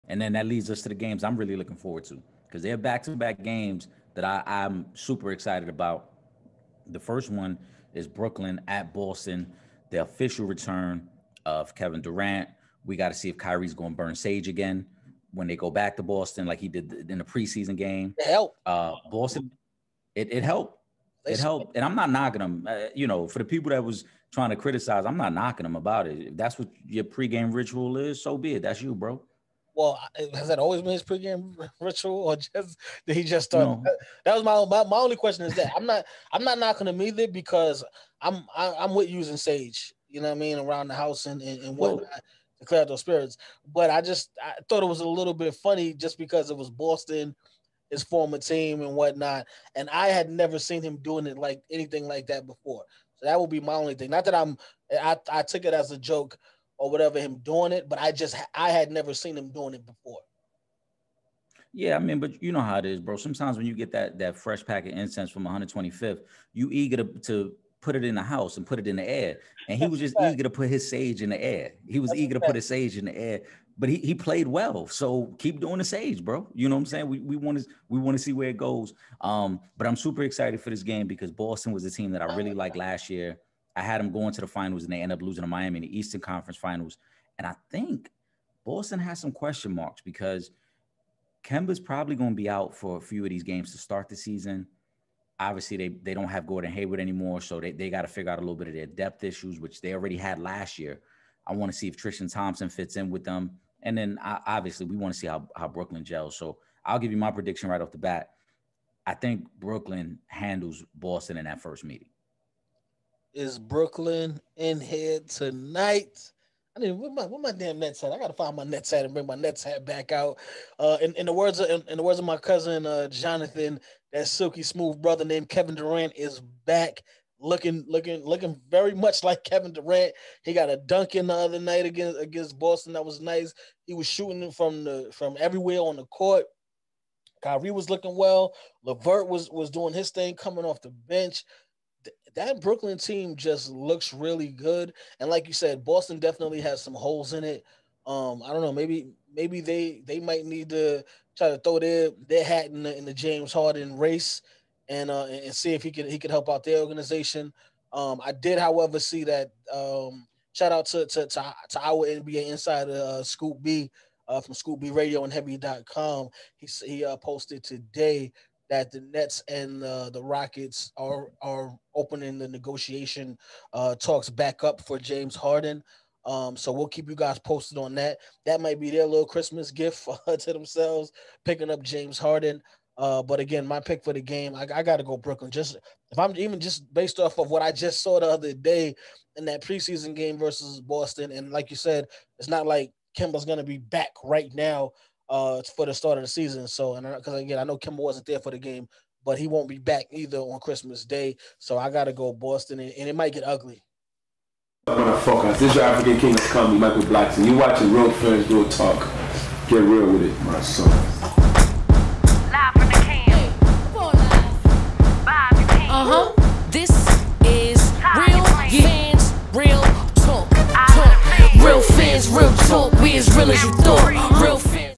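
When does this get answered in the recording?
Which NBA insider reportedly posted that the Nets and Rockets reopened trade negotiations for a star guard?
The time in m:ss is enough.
2:43.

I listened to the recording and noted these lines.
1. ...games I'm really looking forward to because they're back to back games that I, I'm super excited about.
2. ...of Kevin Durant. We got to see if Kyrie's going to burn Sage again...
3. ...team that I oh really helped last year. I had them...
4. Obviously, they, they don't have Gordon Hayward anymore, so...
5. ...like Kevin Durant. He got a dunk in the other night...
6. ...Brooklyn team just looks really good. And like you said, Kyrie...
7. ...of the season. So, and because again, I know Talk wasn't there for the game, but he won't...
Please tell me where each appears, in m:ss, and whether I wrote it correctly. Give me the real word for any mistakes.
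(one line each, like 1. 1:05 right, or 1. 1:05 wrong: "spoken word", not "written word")
1. 0:00 right
2. 0:11 right
3. 1:21 wrong: "liked", not "helped"
4. 1:35 right
5. 2:09 right
6. 2:22 wrong: "Boston", not "Kyrie"
7. 3:16 wrong: "Kemba", not "Talk".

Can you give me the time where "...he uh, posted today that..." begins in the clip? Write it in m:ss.
2:46.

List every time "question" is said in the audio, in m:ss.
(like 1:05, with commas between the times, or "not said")
0:35, 1:29.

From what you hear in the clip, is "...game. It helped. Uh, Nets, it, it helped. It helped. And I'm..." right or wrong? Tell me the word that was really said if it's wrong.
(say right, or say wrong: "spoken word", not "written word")
wrong: "Boston", not "Nets".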